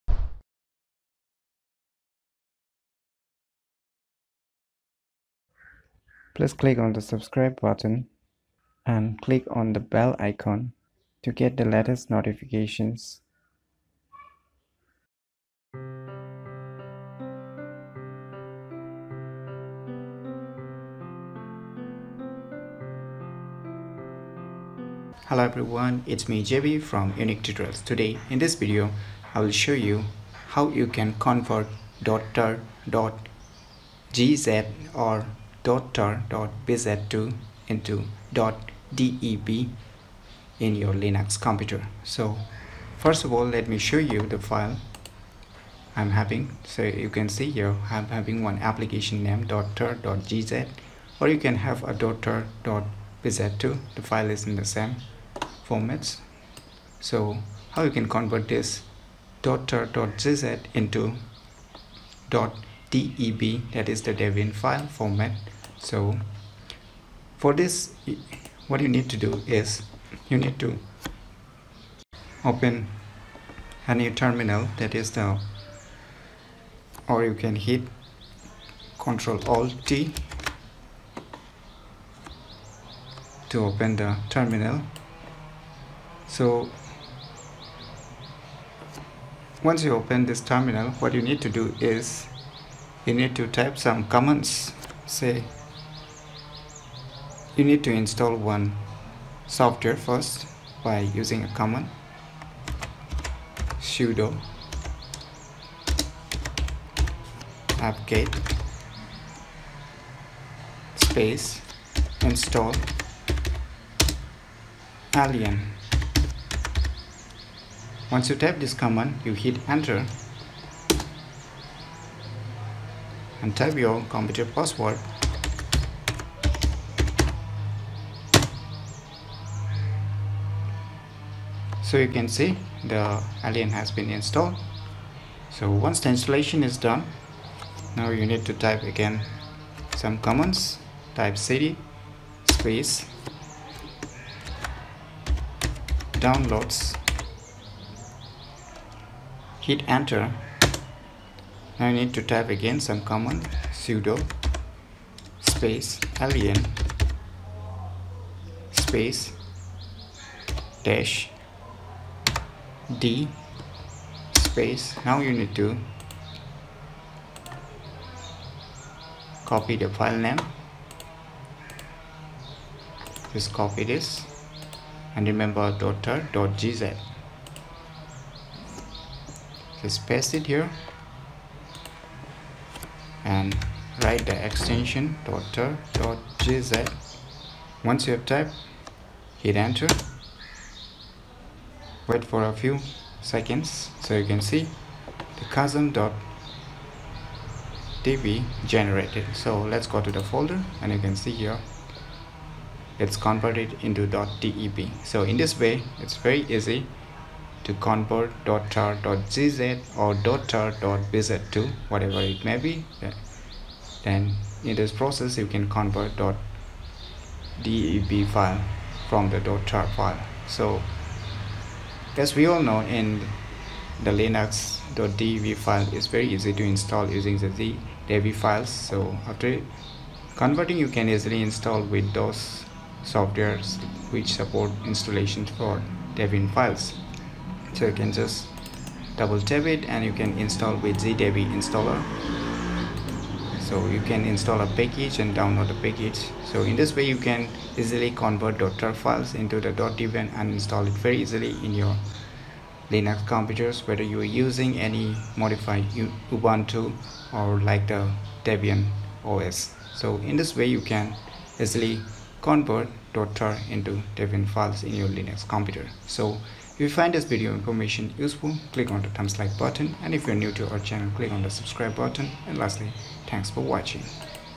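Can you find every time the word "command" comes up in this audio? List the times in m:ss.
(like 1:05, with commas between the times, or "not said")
1:34, 1:41, 1:58, 2:20, 2:33.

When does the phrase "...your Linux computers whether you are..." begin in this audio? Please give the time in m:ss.
4:11.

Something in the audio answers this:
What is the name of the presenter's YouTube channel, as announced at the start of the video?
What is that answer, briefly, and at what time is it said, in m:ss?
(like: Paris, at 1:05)
Unique Tutorials, at 0:27.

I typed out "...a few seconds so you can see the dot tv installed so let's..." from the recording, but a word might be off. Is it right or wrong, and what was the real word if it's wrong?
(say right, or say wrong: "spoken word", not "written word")
wrong: "generated", not "installed".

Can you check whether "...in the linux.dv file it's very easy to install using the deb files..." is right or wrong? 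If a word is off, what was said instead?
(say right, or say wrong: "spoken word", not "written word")
right.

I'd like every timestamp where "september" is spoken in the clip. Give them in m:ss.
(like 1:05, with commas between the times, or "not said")
not said.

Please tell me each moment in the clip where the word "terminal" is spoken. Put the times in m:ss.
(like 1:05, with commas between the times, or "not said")
1:14, 1:24, 1:30.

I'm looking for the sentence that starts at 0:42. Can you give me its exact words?
So first of all, let me show you the file I'm having.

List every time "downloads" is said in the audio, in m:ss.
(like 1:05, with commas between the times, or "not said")
2:26, 4:05.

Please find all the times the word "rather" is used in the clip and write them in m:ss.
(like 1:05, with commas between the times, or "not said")
not said.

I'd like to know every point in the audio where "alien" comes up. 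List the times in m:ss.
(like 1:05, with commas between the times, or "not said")
1:55, 2:13, 2:36.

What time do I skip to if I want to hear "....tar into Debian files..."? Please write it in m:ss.
4:23.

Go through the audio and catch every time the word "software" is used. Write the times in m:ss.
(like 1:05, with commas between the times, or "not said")
1:39, 3:53.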